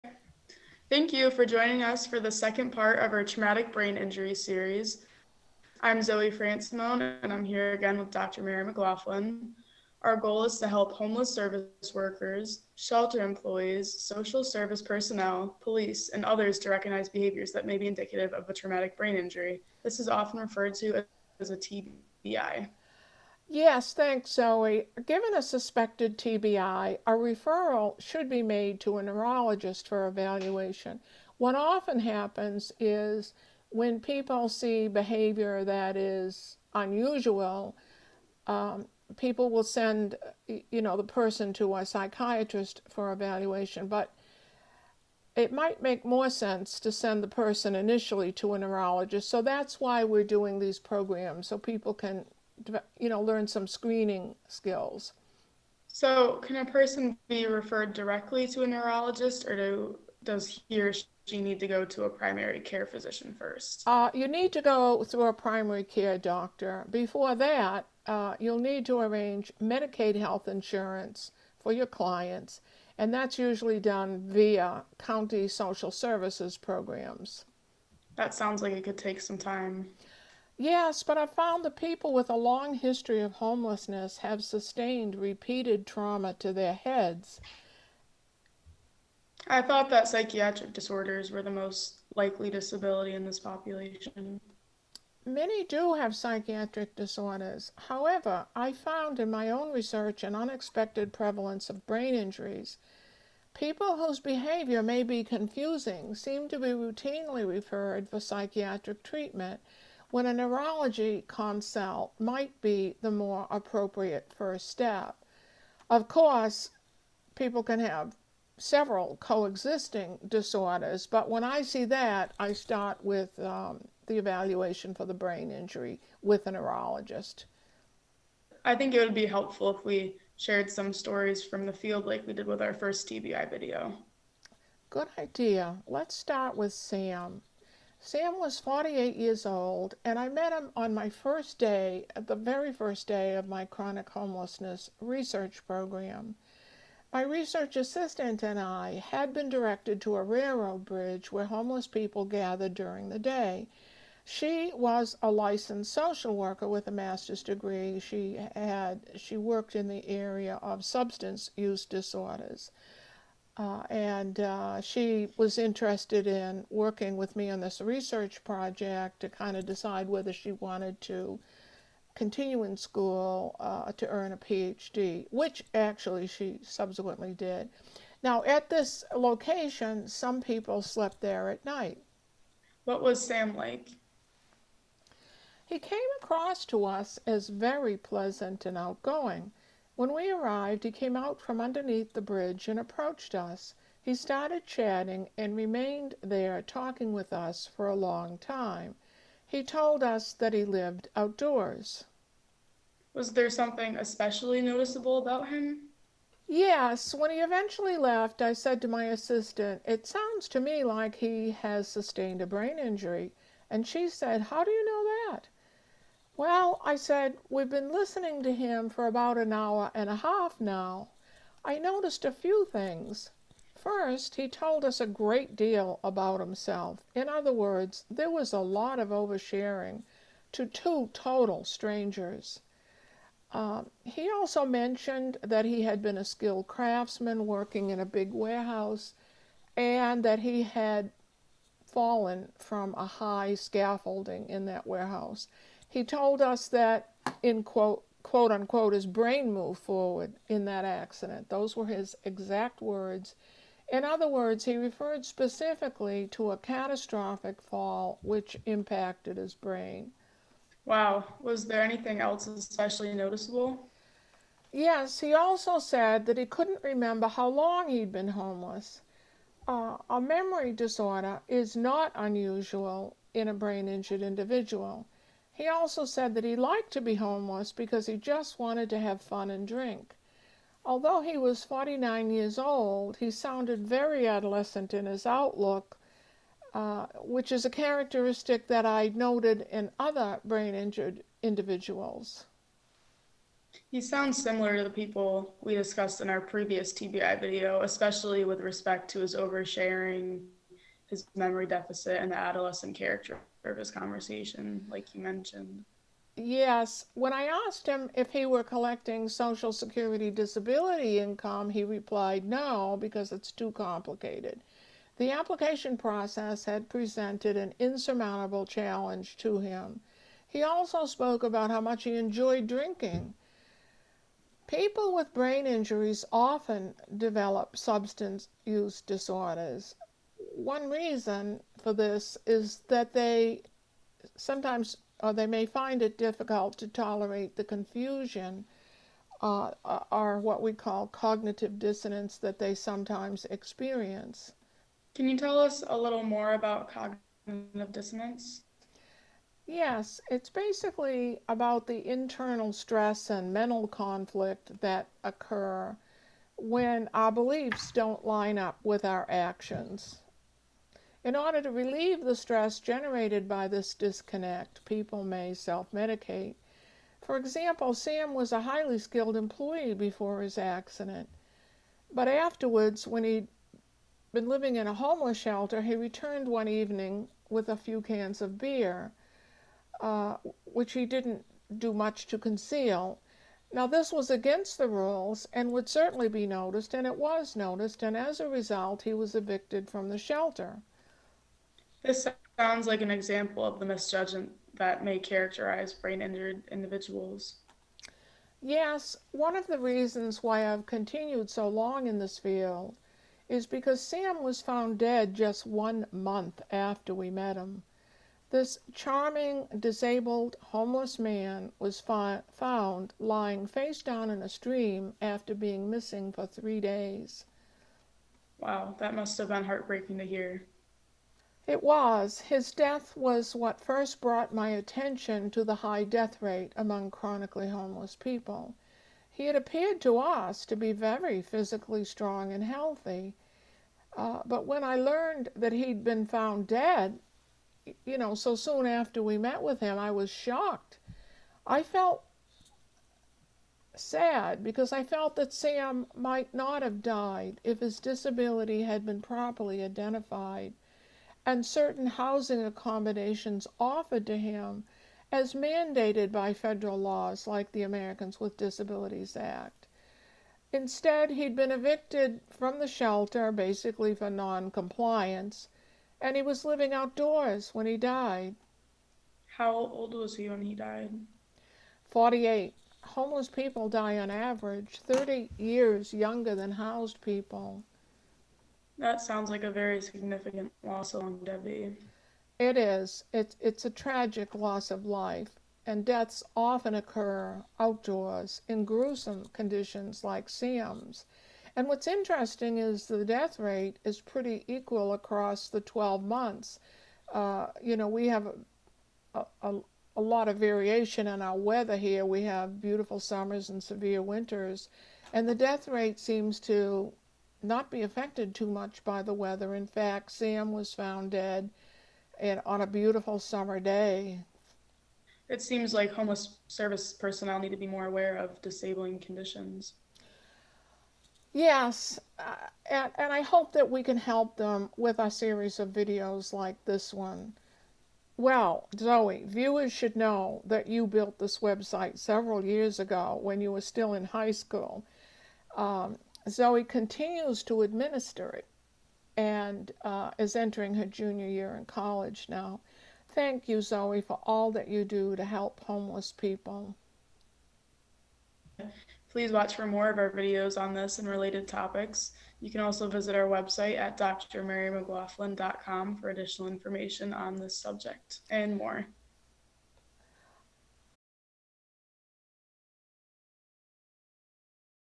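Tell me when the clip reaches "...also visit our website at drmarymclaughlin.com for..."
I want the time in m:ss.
9:12.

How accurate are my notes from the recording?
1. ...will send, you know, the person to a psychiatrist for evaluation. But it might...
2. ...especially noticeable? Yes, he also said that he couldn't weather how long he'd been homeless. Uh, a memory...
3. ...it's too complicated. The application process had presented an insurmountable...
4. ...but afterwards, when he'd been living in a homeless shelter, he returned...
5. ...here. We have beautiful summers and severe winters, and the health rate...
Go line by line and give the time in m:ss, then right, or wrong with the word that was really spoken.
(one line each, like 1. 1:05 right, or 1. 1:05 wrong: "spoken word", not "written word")
1. 0:39 right
2. 4:22 wrong: "remember", not "weather"
3. 5:13 right
4. 6:12 right
5. 8:21 wrong: "death", not "health".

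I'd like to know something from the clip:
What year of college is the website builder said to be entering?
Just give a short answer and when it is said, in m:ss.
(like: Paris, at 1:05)
junior year, at 9:01.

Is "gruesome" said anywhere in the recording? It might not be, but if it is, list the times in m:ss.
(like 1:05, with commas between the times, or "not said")
8:08.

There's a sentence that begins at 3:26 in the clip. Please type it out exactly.
Yes, when he eventually left, I said to my assistant, It sounds to me like he has sustained a brain injury.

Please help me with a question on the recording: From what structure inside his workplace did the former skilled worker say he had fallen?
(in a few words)
high scaffolding.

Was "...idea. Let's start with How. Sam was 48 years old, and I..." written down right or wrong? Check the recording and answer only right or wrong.
wrong.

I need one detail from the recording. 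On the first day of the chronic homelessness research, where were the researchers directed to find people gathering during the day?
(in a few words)
railroad bridge.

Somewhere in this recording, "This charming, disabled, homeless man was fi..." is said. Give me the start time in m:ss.
6:48.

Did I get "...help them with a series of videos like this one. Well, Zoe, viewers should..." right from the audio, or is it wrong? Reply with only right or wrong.
right.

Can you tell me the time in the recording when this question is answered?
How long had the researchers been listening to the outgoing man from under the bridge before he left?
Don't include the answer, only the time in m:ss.
3:39.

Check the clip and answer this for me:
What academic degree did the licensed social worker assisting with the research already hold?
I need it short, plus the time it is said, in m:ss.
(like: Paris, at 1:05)
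master's degree, at 2:36.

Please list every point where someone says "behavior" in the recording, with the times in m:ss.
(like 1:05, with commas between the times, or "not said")
0:17, 0:34, 1:44.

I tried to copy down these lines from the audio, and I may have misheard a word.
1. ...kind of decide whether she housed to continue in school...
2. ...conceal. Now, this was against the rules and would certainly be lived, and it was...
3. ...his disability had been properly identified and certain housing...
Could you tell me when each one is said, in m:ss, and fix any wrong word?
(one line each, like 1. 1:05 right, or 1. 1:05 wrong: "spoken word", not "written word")
1. 2:49 wrong: "wanted", not "housed"
2. 6:22 wrong: "noticed", not "lived"
3. 7:27 right.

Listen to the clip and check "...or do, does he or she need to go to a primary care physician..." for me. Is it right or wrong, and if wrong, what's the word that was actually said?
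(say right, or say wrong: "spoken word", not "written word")
right.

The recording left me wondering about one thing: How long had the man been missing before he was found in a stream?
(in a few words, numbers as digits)
3 days.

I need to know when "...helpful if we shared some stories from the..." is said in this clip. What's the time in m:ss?
2:09.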